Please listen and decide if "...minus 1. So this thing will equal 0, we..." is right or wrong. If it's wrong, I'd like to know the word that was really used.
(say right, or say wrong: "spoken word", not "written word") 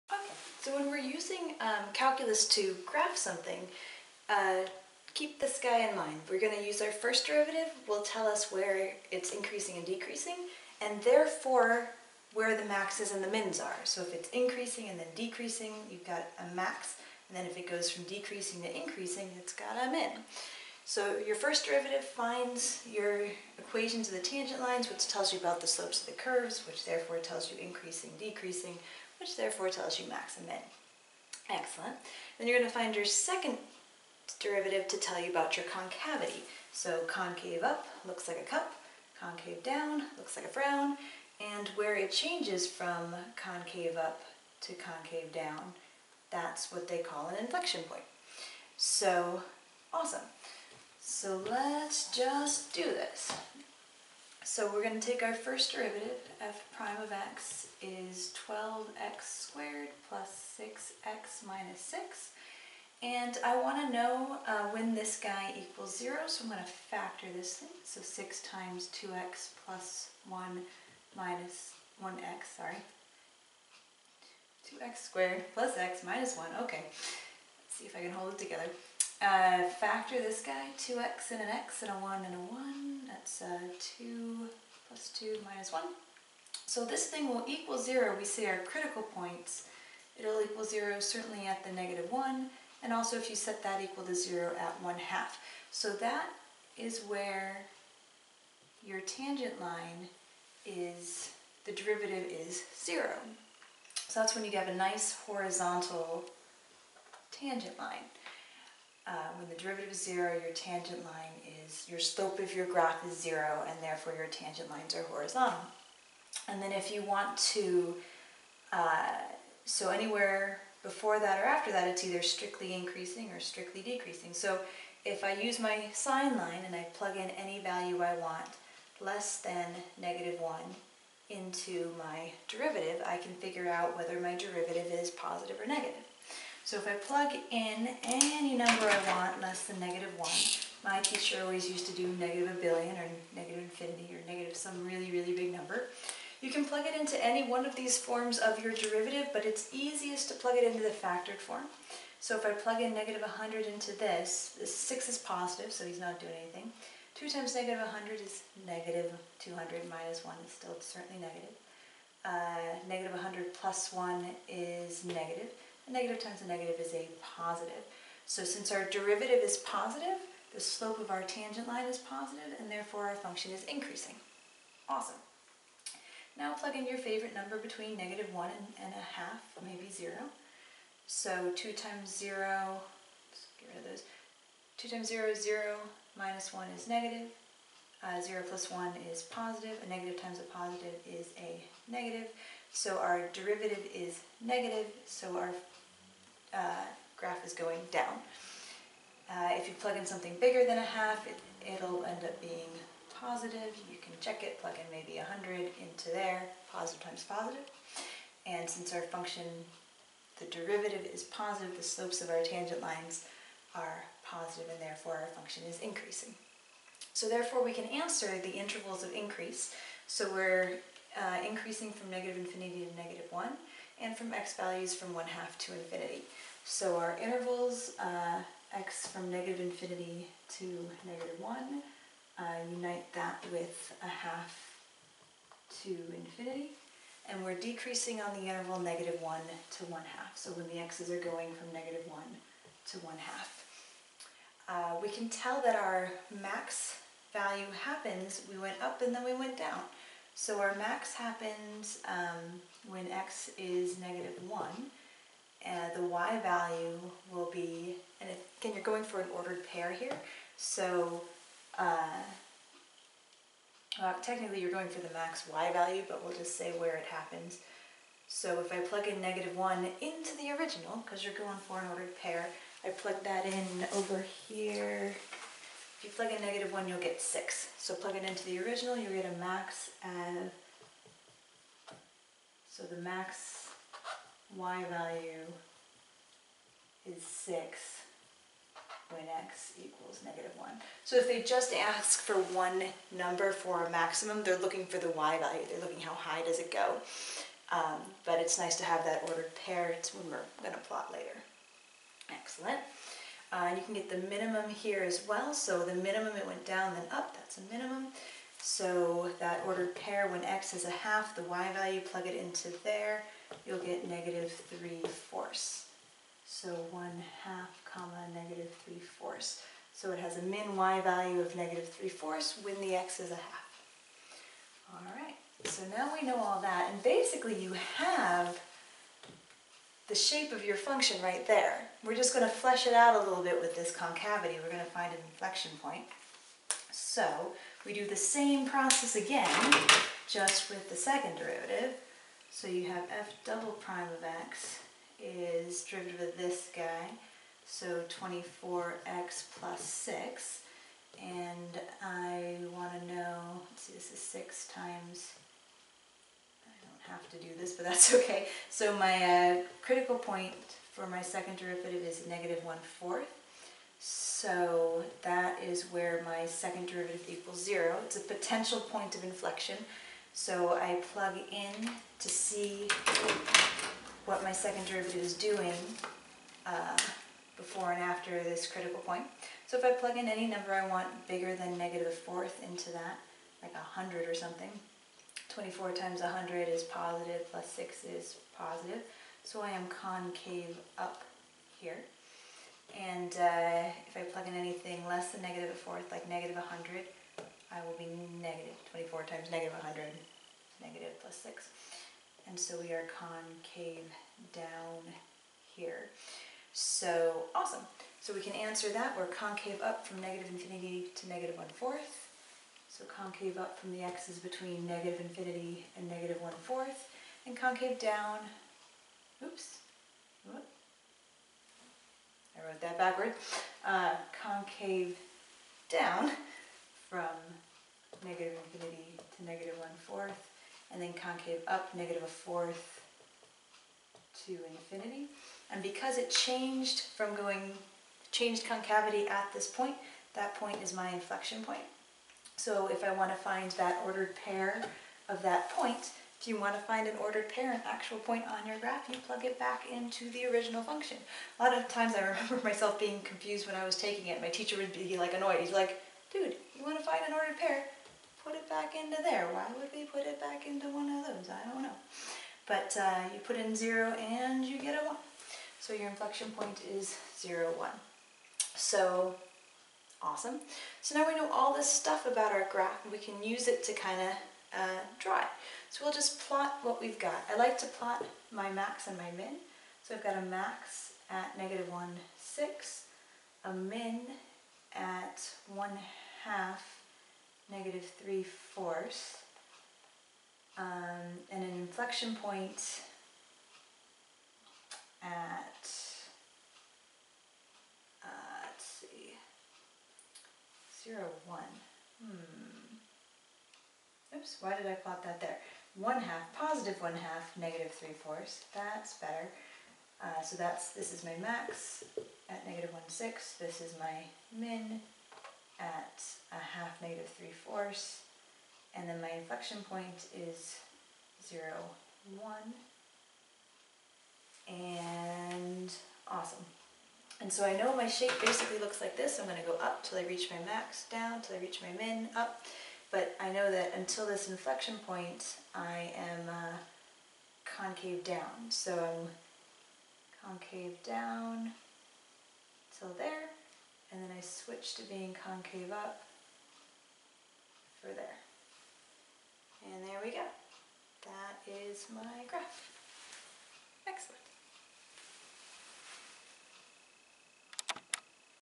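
right.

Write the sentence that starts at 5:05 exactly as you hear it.
So the minimum, it went down, then up, that's a minimum.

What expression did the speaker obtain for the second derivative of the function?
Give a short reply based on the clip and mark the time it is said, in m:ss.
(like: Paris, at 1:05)
24x + 6, at 5:48.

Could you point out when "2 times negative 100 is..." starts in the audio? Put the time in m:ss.
2:37.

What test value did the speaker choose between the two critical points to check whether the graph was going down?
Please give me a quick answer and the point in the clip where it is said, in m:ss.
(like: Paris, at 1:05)
0, at 2:59.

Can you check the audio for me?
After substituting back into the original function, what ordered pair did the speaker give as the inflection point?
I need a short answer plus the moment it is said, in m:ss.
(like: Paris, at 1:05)
(0, 1), at 7:47.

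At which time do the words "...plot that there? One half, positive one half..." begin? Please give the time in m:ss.
8:24.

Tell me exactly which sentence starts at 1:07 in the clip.
So 6 times 2x plus 1 minus 1x, sorry.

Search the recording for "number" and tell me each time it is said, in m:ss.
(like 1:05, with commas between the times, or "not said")
2:18, 2:25, 2:57, 4:53, 6:20.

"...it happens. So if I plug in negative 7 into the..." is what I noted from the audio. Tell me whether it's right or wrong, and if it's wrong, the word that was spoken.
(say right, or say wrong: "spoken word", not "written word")
wrong: "1", not "7".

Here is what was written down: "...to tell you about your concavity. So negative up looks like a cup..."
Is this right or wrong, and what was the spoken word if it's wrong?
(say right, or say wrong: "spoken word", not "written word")
wrong: "concave", not "negative".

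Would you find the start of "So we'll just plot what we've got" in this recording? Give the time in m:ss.
7:55.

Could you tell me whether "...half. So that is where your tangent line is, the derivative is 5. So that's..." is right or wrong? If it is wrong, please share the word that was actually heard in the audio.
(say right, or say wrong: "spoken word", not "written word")
wrong: "0", not "5".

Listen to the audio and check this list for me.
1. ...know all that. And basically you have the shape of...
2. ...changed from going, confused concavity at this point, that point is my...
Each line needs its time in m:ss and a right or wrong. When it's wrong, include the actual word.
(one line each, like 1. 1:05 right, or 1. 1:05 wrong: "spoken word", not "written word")
1. 5:26 right
2. 7:16 wrong: "changed", not "confused".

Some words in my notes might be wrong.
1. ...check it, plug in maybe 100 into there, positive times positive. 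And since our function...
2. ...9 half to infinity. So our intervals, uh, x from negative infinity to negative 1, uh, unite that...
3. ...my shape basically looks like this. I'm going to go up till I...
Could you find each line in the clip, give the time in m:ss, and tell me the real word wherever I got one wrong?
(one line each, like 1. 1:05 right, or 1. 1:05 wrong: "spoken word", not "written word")
1. 3:24 right
2. 3:45 wrong: "1", not "9"
3. 8:47 right.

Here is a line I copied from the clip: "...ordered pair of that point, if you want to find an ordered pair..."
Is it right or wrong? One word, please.
right.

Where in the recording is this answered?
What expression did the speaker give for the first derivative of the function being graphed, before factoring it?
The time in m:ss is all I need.
0:58.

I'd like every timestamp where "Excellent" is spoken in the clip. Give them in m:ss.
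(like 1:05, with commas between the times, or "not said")
0:31, 5:02, 9:14.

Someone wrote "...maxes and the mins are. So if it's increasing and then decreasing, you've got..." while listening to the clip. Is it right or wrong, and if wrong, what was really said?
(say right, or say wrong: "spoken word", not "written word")
right.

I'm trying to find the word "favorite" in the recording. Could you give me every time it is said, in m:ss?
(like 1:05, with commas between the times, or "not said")
2:56.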